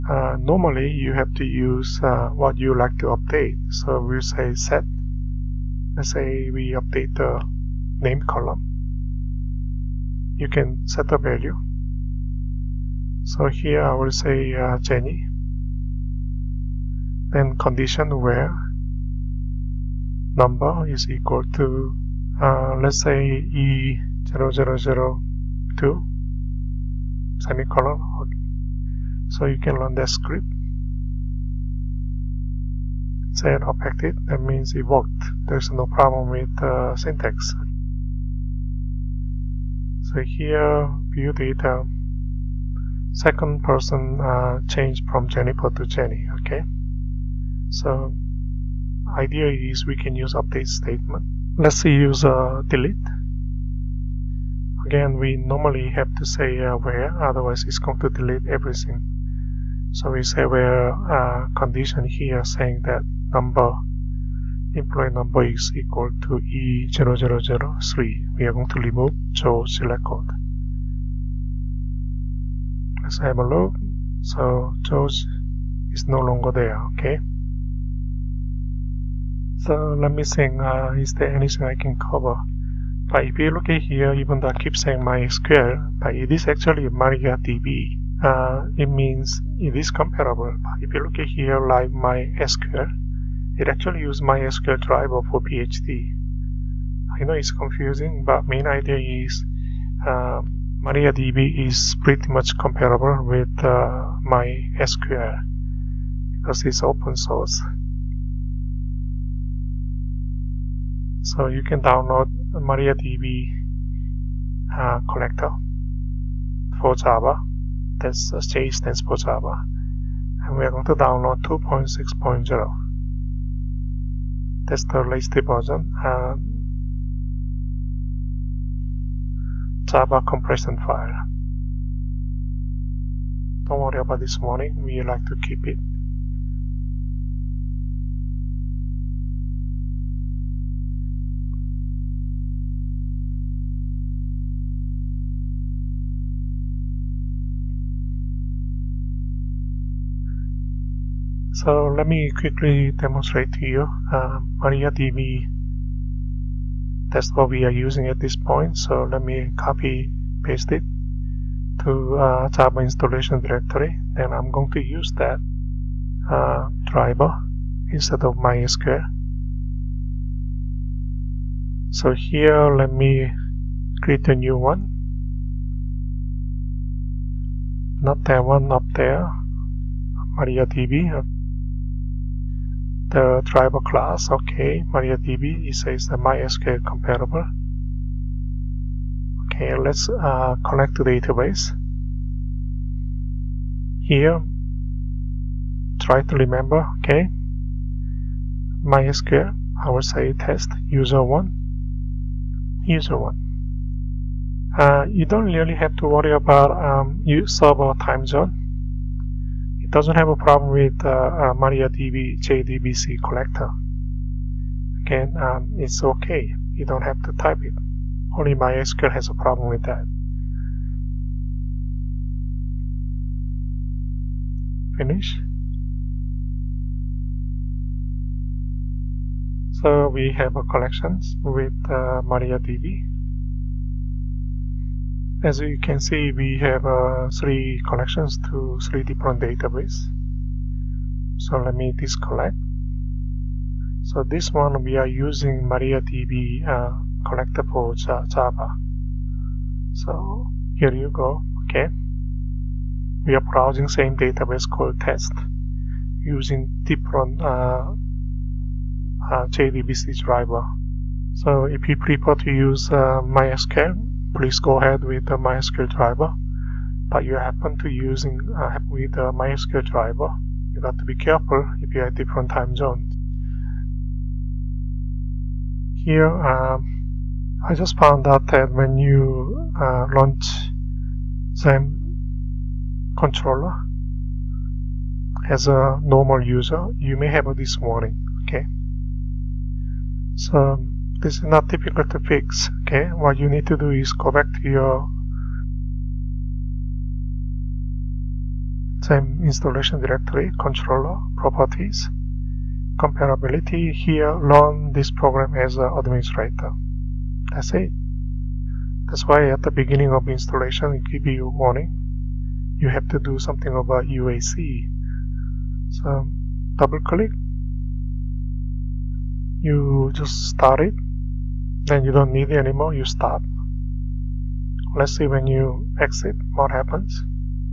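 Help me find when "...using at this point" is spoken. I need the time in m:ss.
2:37.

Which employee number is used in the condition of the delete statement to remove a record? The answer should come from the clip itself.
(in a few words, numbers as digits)
E0003.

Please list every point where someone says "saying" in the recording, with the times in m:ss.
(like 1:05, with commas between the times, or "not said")
1:02, 1:24.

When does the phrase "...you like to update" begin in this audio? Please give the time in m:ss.
0:02.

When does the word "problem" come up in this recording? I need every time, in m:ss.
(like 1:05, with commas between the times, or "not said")
0:35, 3:30, 3:39.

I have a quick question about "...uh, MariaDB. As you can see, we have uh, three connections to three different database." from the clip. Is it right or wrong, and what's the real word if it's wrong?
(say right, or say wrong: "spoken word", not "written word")
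right.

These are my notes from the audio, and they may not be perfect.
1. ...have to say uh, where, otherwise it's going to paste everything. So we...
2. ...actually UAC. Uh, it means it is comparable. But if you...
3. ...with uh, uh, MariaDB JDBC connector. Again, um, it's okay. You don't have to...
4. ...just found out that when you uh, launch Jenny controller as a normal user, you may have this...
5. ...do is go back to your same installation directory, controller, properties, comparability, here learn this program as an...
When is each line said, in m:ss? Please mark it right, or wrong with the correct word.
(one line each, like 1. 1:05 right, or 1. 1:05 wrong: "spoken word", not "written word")
1. 0:55 wrong: "delete", not "paste"
2. 1:26 wrong: "MariaDB", not "UAC"
3. 3:30 right
4. 4:37 wrong: "XAMPP", not "Jenny"
5. 4:53 right.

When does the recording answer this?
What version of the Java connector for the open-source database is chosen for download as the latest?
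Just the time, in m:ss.
2:01.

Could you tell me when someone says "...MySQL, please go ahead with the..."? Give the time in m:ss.
4:23.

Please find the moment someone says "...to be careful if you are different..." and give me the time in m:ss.
4:30.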